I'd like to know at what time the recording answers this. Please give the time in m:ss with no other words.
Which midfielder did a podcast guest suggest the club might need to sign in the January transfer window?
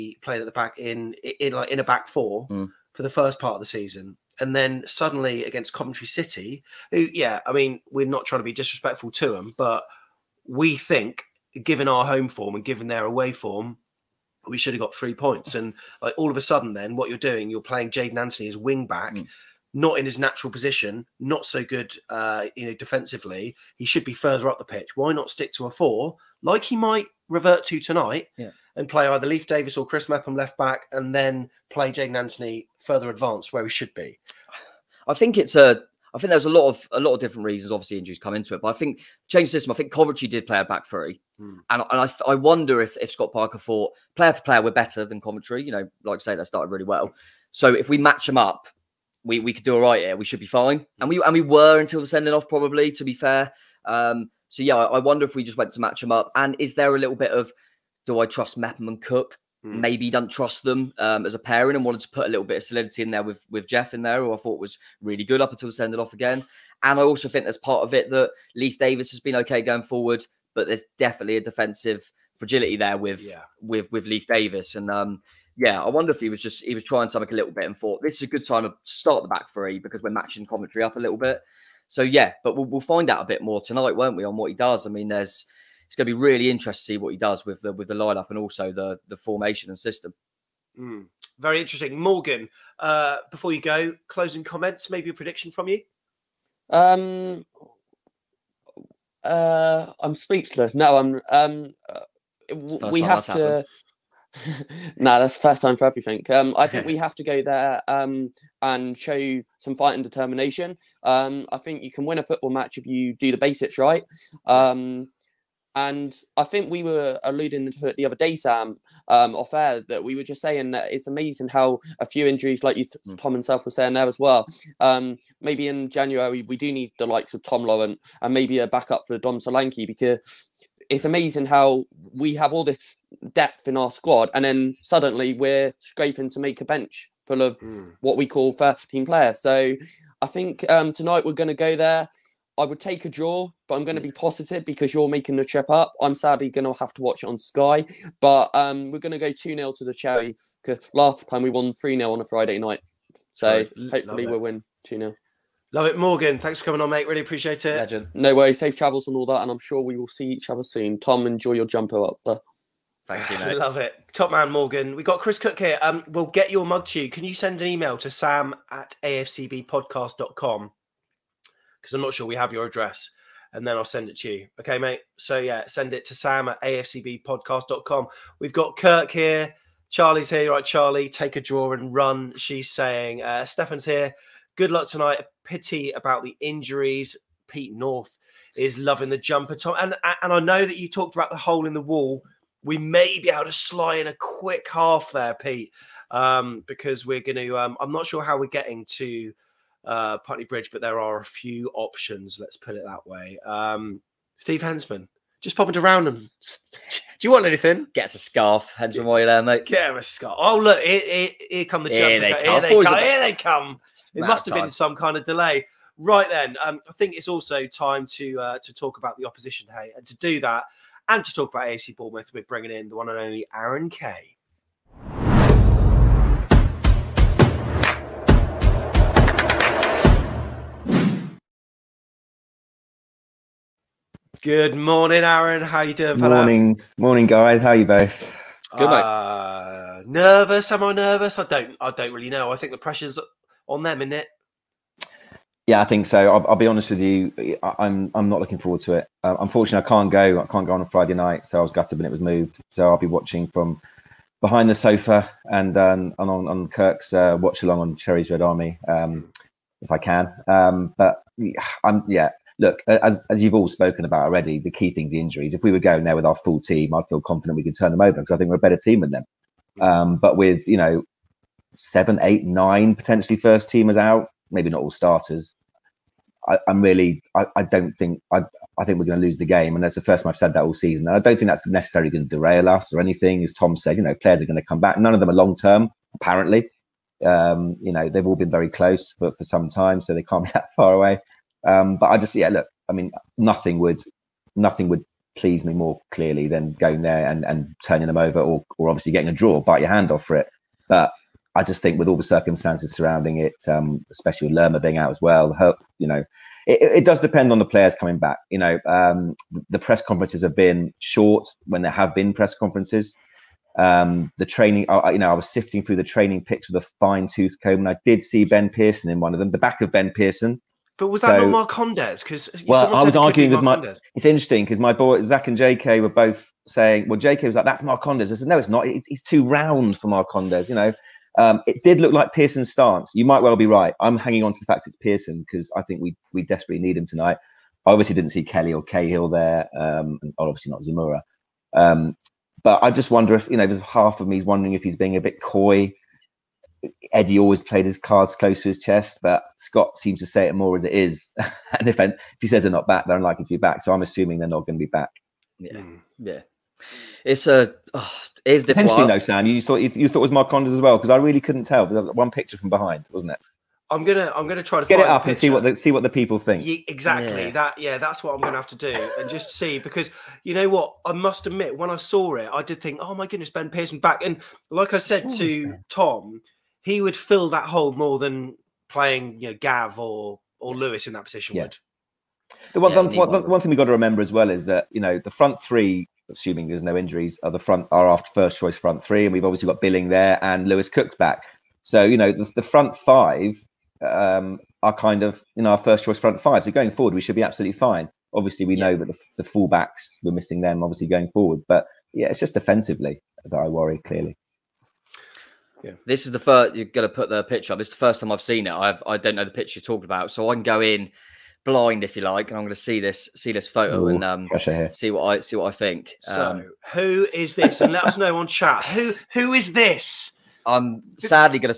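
2:07.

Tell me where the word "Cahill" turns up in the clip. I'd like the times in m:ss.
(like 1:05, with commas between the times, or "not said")
5:38.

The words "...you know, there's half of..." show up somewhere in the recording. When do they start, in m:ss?
5:43.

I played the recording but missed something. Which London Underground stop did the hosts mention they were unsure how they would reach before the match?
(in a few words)
Putney Bridge.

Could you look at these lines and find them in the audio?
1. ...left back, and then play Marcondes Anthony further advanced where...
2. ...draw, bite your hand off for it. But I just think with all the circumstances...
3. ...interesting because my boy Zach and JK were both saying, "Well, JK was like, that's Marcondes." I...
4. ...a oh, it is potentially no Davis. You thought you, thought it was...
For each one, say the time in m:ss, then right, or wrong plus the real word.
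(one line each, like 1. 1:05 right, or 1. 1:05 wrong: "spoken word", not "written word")
1. 0:30 wrong: "Jaidon", not "Marcondes"
2. 4:59 right
3. 5:24 right
4. 5:57 wrong: "Sam", not "Davis".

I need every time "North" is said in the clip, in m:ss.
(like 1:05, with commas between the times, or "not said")
3:07.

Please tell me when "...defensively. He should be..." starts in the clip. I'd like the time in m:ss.
0:22.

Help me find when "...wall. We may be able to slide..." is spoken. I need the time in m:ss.
3:11.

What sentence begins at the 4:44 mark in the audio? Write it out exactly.
None of them are long term, apparently.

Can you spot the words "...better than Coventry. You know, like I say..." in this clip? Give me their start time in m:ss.
0:44.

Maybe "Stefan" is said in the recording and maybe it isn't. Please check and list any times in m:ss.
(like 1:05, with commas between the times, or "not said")
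3:03.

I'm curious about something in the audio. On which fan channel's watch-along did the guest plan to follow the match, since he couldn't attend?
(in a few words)
Cherry's Red Army.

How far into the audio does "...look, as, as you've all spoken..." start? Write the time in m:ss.
4:22.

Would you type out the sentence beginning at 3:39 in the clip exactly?
Hey, and to do that, and to talk about AFC Bournemouth, we're bringing in the one and only Aaron Kay.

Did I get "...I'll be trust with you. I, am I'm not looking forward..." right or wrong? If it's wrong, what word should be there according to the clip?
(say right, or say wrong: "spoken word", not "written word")
wrong: "honest", not "trust".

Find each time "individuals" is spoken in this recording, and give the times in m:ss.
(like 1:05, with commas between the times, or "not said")
not said.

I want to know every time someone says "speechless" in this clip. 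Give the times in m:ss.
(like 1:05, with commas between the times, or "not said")
1:40.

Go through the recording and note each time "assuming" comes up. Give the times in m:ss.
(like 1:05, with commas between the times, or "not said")
5:54, 6:26.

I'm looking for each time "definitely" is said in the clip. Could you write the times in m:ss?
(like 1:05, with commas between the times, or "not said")
1:10.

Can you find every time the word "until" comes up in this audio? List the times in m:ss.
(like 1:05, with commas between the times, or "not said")
0:51, 1:05.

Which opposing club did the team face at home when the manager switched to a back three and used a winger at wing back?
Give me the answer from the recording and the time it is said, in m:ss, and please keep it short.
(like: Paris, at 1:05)
Coventry City, at 0:05.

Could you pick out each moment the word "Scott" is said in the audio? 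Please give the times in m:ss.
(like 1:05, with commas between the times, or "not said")
0:43, 5:49.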